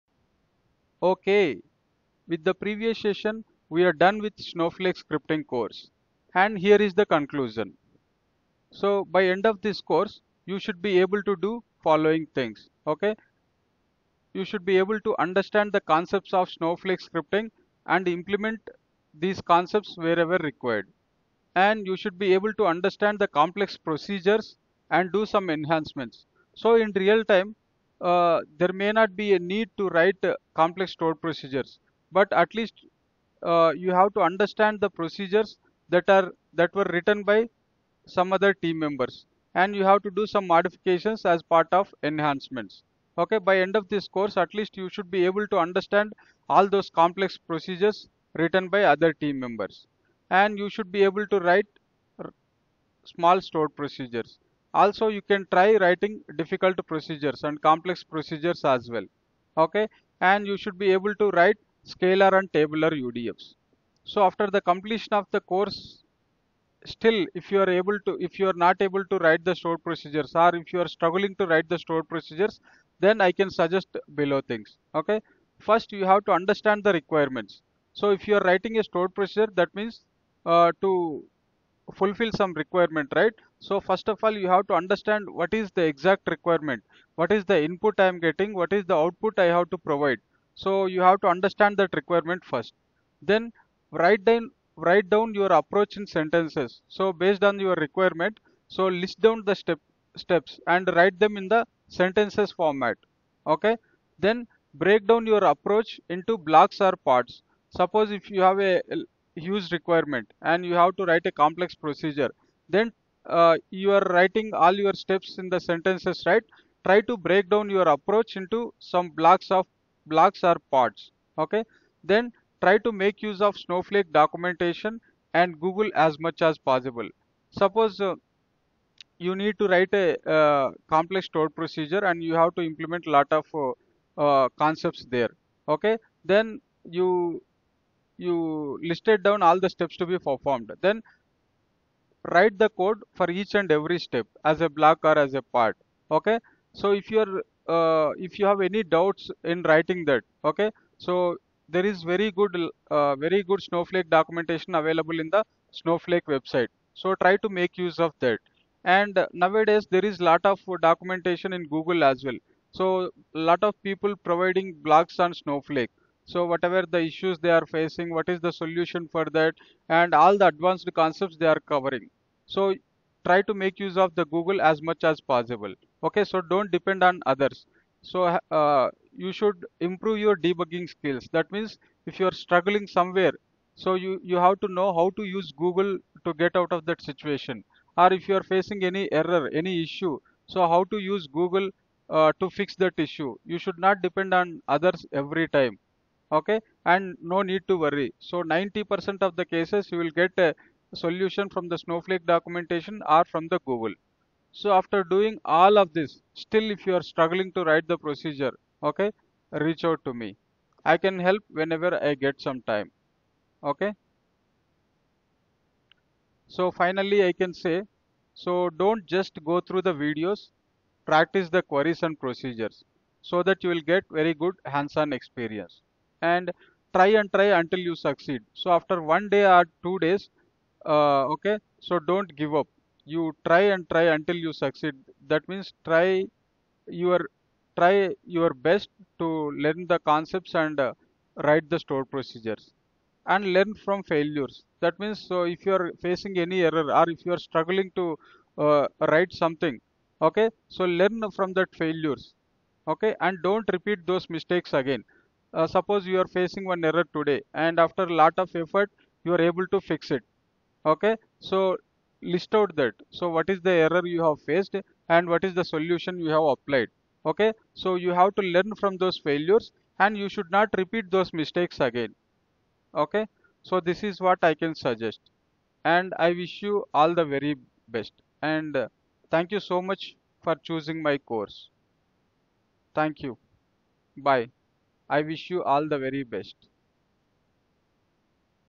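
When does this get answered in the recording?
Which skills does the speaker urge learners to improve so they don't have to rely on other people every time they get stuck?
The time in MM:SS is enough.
03:00.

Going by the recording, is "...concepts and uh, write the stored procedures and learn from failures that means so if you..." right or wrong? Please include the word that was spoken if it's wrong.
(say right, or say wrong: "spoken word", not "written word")
right.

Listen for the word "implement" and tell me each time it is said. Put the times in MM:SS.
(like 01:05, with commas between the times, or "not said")
00:18, 02:12.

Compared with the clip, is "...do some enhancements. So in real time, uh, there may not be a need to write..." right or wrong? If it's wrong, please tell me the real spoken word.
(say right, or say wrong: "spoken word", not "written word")
right.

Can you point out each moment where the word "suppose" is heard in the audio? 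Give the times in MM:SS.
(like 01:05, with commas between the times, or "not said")
01:47, 02:07, 04:15.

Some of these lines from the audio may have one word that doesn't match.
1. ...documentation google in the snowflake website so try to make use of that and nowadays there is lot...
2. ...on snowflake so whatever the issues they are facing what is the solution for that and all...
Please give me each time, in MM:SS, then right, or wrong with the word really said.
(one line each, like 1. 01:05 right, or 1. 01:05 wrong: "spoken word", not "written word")
1. 02:34 wrong: "available", not "google"
2. 02:45 right.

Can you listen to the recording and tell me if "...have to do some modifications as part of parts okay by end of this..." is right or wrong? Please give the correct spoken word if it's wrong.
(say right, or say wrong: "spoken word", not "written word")
wrong: "enhancements", not "parts".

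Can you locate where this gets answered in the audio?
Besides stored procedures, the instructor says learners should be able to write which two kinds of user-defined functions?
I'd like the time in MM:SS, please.
01:01.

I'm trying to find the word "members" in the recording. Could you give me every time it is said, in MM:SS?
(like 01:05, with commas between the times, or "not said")
00:38, 00:49.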